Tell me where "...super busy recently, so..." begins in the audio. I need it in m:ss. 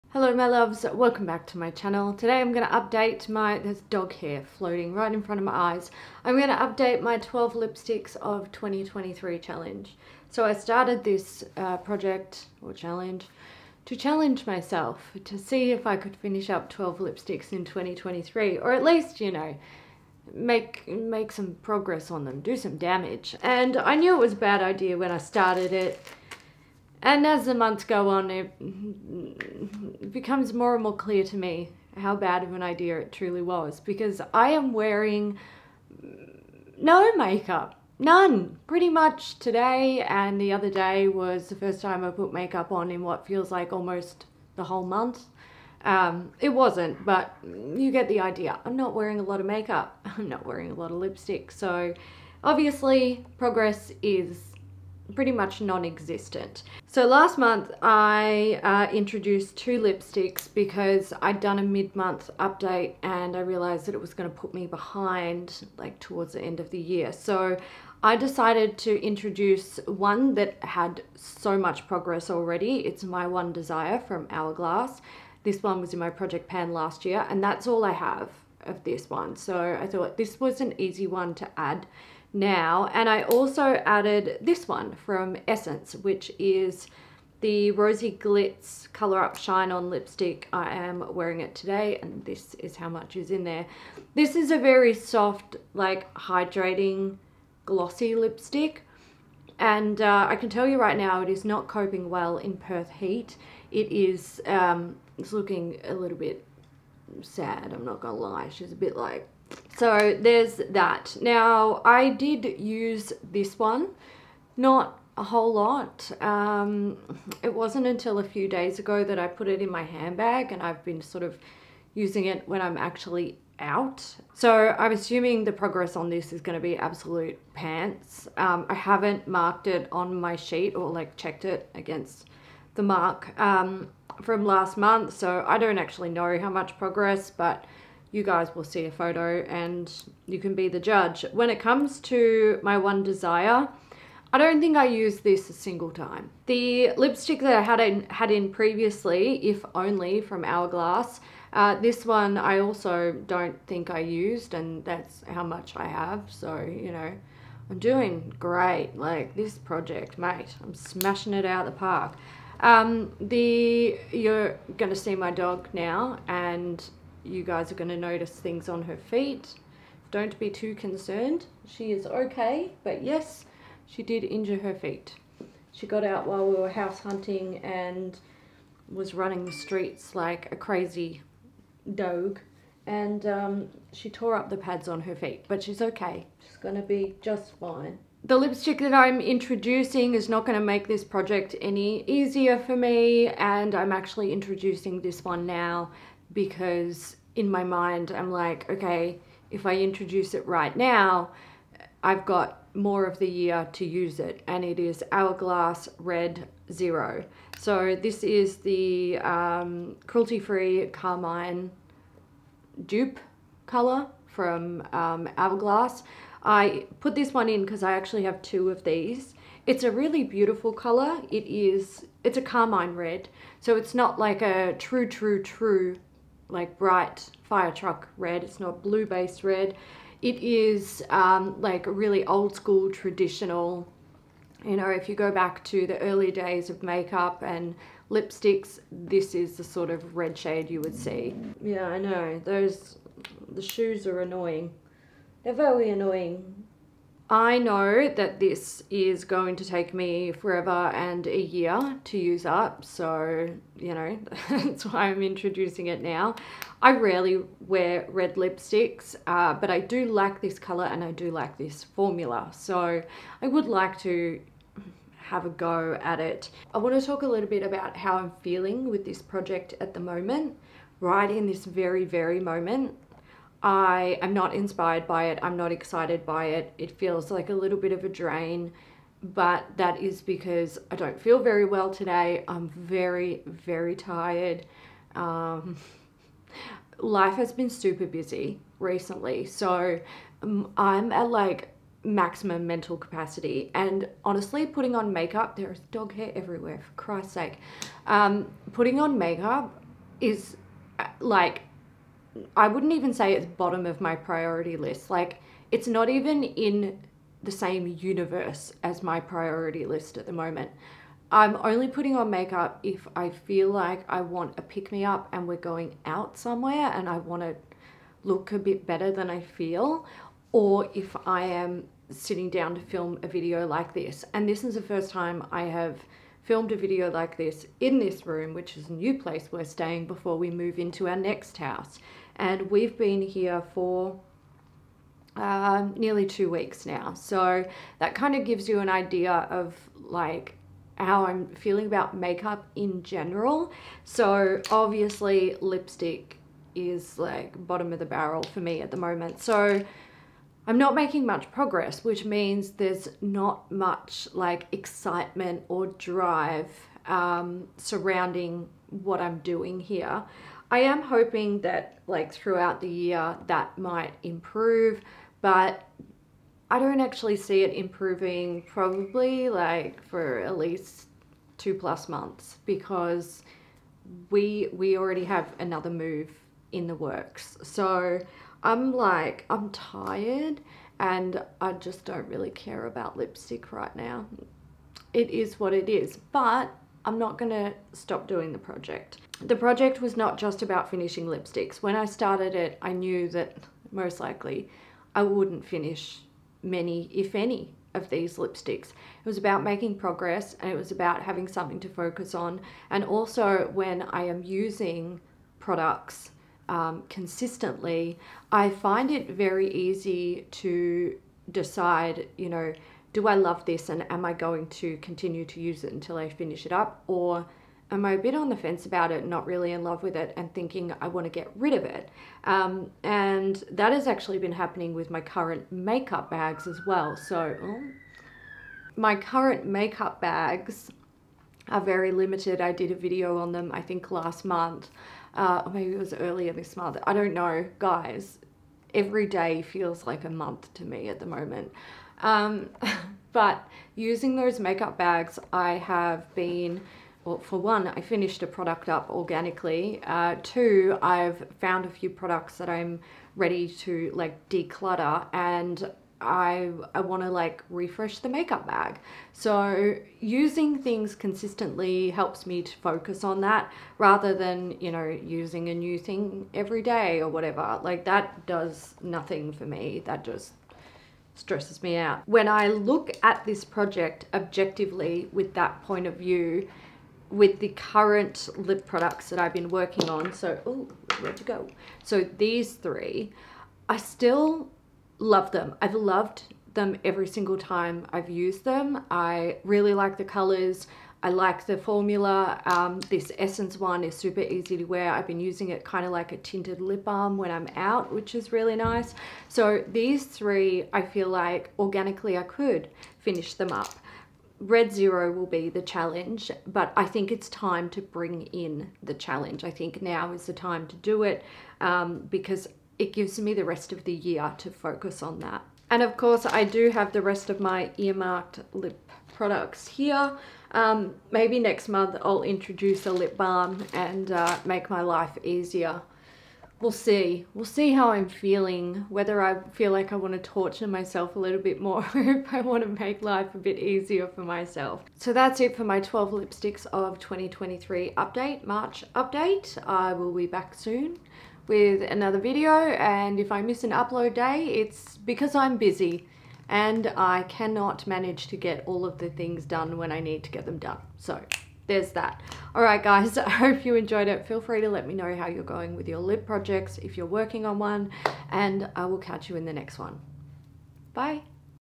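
4:47.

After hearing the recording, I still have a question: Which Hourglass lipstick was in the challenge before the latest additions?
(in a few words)
If Only.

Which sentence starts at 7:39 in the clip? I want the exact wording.
So using things consistently helps me to focus on that rather than, you know, using a new thing every day or whatever.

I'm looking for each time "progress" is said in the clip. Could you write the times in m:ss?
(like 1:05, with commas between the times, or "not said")
0:21, 0:53, 1:11, 2:05, 2:16, 5:51, 6:39.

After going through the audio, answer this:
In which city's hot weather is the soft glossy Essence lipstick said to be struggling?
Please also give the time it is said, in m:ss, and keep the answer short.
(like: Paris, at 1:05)
Perth, at 1:42.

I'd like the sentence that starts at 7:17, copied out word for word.
I don't know, guys every day feels like a month to me at the moment.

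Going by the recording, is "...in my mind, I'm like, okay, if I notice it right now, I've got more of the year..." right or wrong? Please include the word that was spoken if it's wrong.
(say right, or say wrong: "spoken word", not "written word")
wrong: "introduce", not "notice".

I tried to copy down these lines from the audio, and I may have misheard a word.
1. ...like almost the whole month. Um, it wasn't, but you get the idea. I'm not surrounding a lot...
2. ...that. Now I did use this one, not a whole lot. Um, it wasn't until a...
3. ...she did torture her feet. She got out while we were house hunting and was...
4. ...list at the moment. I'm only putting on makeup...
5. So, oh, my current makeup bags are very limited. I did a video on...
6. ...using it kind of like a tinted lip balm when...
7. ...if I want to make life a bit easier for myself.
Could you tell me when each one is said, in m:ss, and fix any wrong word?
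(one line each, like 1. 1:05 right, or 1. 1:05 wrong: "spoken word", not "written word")
1. 0:43 wrong: "wearing", not "surrounding"
2. 1:50 right
3. 2:53 wrong: "injure", not "torture"
4. 5:09 right
5. 7:07 right
6. 8:15 right
7. 8:52 right.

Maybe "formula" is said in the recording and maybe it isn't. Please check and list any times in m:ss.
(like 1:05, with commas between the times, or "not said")
4:21, 8:11.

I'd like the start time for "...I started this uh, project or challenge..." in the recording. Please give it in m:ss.
0:10.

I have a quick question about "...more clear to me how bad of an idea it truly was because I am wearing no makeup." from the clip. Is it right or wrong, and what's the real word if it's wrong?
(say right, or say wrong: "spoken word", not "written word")
right.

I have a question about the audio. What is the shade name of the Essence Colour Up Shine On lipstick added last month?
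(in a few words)
Rosey Glitz.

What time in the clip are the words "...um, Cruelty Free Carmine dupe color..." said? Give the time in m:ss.
3:29.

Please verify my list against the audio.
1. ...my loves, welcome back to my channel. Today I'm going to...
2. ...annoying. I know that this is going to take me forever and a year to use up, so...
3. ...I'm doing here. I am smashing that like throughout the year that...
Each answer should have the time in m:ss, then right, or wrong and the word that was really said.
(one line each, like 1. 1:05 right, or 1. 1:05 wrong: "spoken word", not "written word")
1. 0:00 right
2. 4:05 right
3. 5:59 wrong: "hoping", not "smashing".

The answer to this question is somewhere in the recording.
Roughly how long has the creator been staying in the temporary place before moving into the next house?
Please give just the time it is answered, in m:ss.
5:35.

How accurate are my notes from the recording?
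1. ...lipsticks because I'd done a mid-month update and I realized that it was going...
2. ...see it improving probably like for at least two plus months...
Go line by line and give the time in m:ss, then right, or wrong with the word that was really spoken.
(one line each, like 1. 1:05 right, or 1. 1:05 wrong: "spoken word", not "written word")
1. 0:59 right
2. 6:07 right.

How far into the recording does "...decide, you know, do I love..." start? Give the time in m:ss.
6:51.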